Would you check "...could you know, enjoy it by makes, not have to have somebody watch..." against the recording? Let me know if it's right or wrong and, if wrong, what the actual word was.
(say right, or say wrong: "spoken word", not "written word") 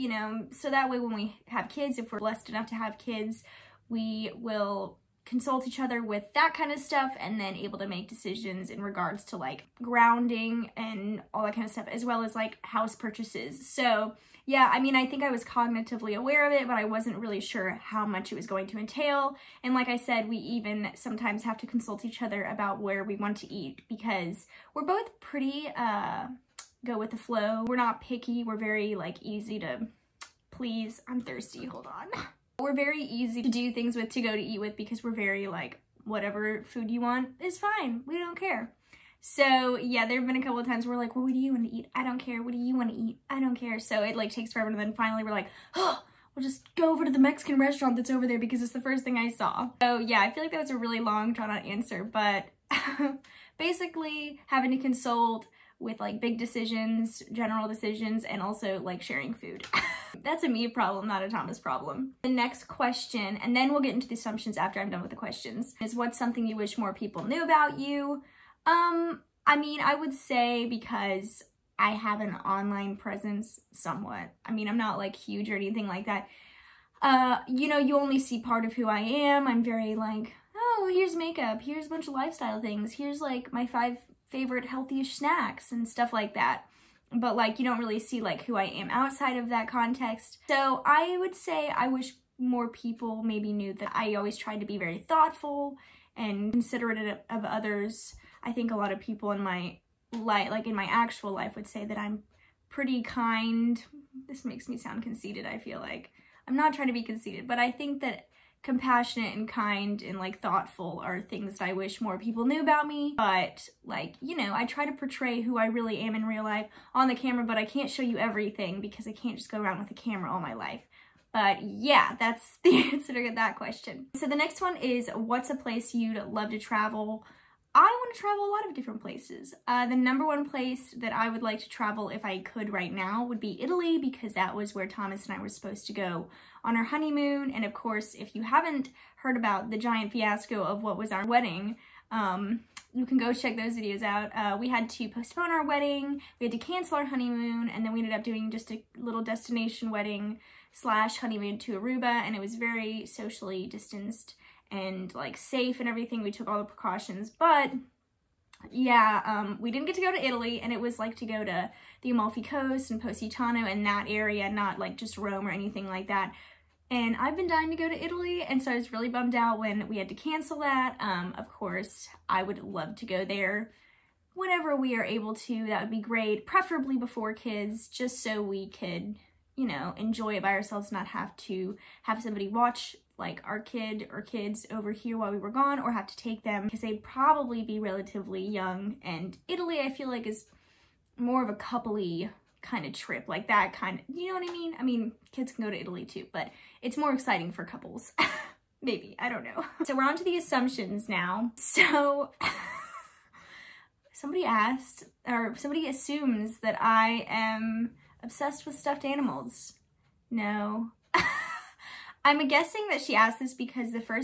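wrong: "ourselves", not "makes".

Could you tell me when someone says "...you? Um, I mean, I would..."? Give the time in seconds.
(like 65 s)
67 s.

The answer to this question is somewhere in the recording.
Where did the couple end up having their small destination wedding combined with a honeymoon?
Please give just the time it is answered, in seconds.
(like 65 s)
151 s.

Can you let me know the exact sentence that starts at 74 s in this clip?
I mean, I'm not like huge or anything like that.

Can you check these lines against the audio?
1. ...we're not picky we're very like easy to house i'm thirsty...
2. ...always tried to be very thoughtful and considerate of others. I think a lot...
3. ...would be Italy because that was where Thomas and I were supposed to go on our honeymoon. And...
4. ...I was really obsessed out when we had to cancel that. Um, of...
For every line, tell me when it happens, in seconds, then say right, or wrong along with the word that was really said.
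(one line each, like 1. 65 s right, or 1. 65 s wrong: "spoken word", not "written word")
1. 27 s wrong: "please", not "house"
2. 94 s right
3. 133 s right
4. 168 s wrong: "bummed", not "obsessed".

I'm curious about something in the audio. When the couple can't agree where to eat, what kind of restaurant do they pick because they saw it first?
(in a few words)
Mexican restaurant.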